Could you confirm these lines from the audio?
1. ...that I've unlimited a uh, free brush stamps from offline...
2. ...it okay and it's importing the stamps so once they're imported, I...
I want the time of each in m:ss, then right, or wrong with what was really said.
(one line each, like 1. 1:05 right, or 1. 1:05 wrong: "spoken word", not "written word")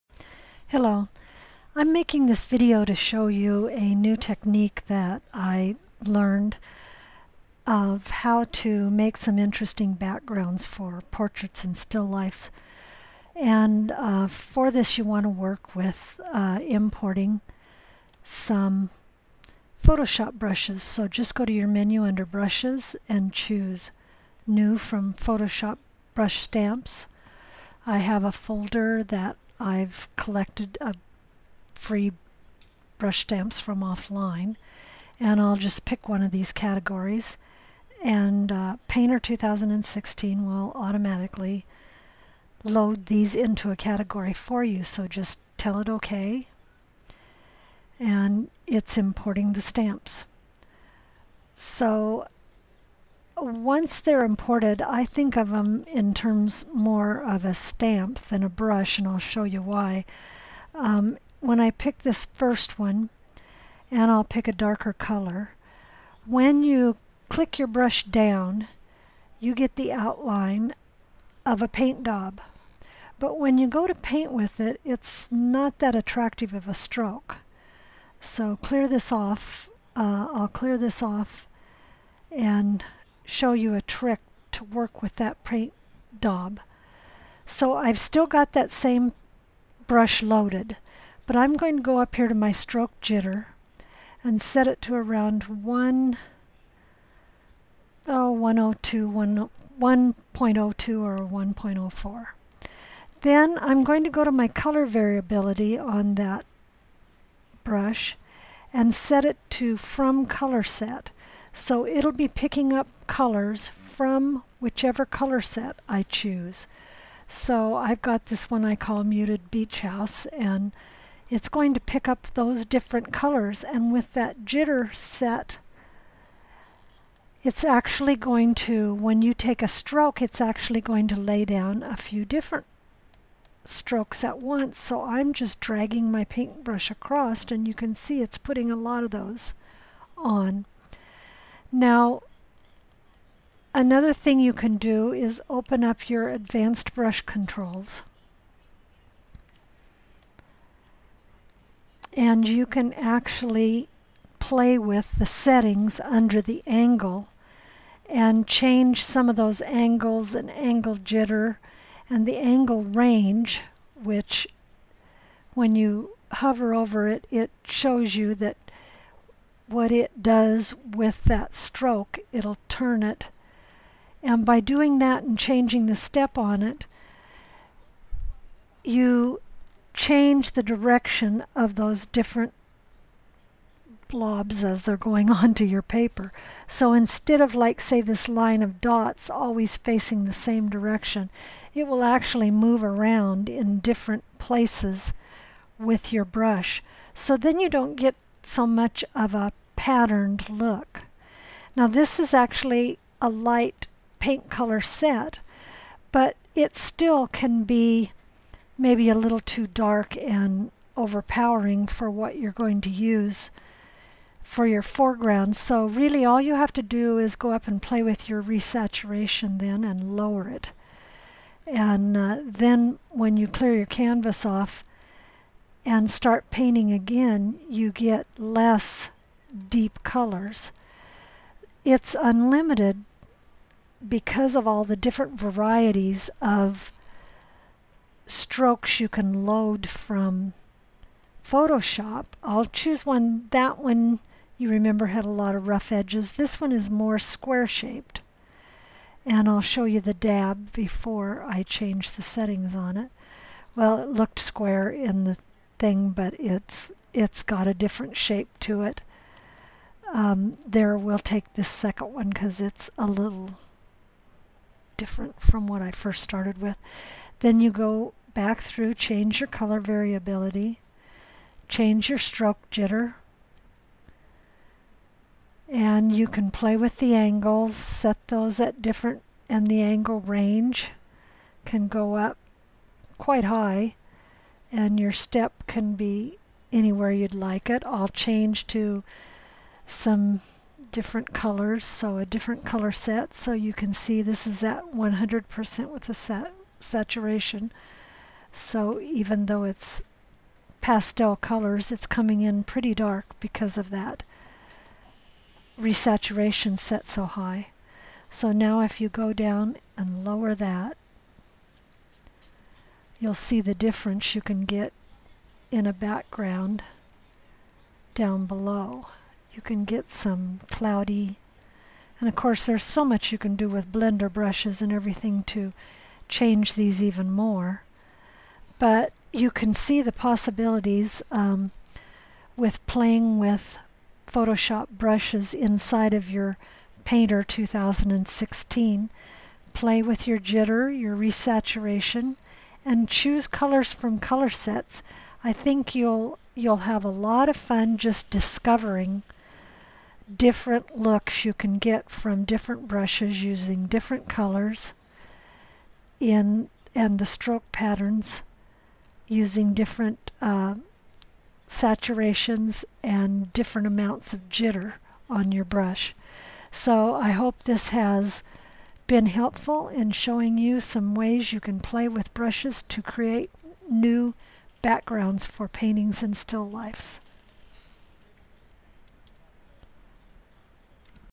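1. 0:29 wrong: "collected", not "unlimited"
2. 0:45 right.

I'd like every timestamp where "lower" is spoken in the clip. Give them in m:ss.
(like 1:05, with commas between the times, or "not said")
3:40, 5:10.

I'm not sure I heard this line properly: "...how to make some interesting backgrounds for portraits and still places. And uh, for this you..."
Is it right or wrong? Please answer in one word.
wrong.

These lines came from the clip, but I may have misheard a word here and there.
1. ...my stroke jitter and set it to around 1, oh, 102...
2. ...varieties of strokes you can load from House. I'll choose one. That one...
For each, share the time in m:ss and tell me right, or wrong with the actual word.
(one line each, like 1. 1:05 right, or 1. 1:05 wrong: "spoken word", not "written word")
1. 1:32 right
2. 3:55 wrong: "Photoshop", not "House".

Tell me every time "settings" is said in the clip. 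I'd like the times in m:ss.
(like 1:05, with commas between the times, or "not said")
2:35, 4:12.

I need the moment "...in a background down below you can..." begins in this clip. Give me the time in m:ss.
5:15.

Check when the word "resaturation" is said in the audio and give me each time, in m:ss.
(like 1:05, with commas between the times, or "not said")
3:38, 5:05, 5:41.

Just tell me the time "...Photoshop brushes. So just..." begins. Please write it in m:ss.
0:19.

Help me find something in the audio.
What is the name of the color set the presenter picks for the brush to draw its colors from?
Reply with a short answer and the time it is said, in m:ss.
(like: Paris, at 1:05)
Muted Beach House, at 1:59.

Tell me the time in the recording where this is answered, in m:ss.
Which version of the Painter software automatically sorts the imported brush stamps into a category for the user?
0:38.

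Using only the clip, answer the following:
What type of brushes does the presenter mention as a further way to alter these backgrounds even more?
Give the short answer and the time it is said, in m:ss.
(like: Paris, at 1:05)
blender brushes, at 5:23.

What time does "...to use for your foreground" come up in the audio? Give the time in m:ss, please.
3:32.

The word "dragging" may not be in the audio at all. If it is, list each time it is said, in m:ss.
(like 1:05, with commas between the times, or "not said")
2:15.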